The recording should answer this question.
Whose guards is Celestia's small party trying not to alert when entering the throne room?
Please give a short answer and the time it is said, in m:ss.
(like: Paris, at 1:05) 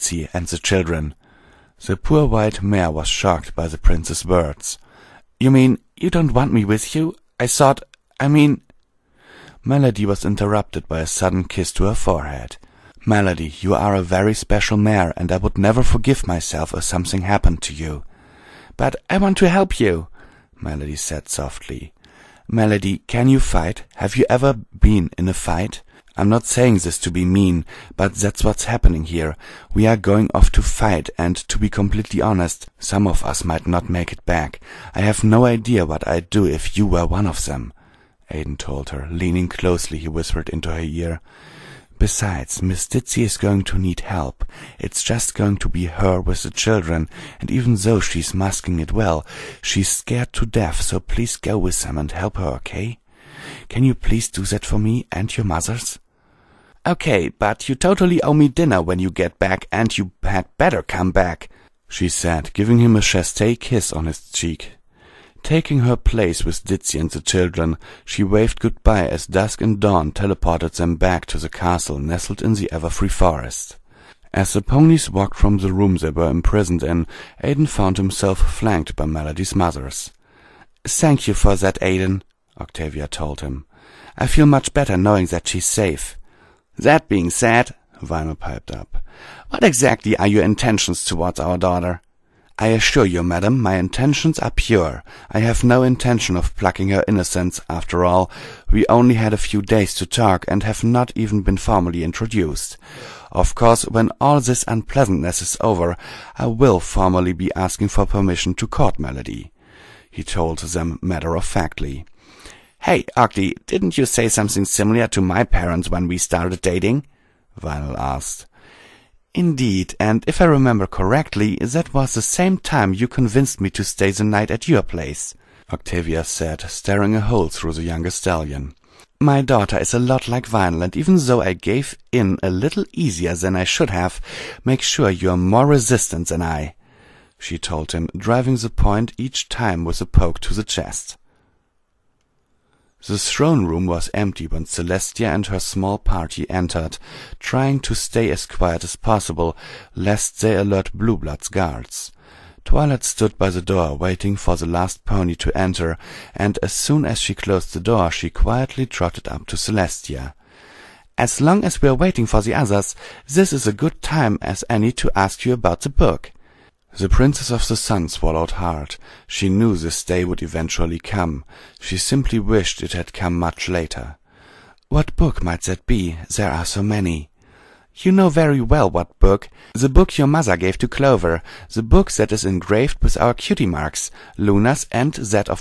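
Blueblood's, at 2:30.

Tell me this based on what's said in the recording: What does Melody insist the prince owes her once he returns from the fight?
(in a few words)
Dinner.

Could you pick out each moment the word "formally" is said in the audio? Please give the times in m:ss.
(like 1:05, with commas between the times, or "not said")
1:41, 1:46.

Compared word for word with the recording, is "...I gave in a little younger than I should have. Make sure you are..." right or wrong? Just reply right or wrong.
wrong.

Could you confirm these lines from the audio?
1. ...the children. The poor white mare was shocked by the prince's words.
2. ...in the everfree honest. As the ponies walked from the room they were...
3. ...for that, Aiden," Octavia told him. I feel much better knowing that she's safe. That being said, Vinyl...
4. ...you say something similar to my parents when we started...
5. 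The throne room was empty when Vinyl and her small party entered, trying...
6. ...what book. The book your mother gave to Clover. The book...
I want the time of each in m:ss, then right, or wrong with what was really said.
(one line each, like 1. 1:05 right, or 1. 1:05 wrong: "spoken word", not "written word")
1. 0:00 right
2. 1:12 wrong: "forest", not "honest"
3. 1:21 right
4. 1:53 right
5. 2:23 wrong: "Celestia", not "Vinyl"
6. 2:58 right.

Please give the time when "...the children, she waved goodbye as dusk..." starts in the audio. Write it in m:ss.
1:07.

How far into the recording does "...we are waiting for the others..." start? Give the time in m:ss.
2:41.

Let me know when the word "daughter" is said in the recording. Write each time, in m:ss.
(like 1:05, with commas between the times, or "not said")
1:31, 2:09.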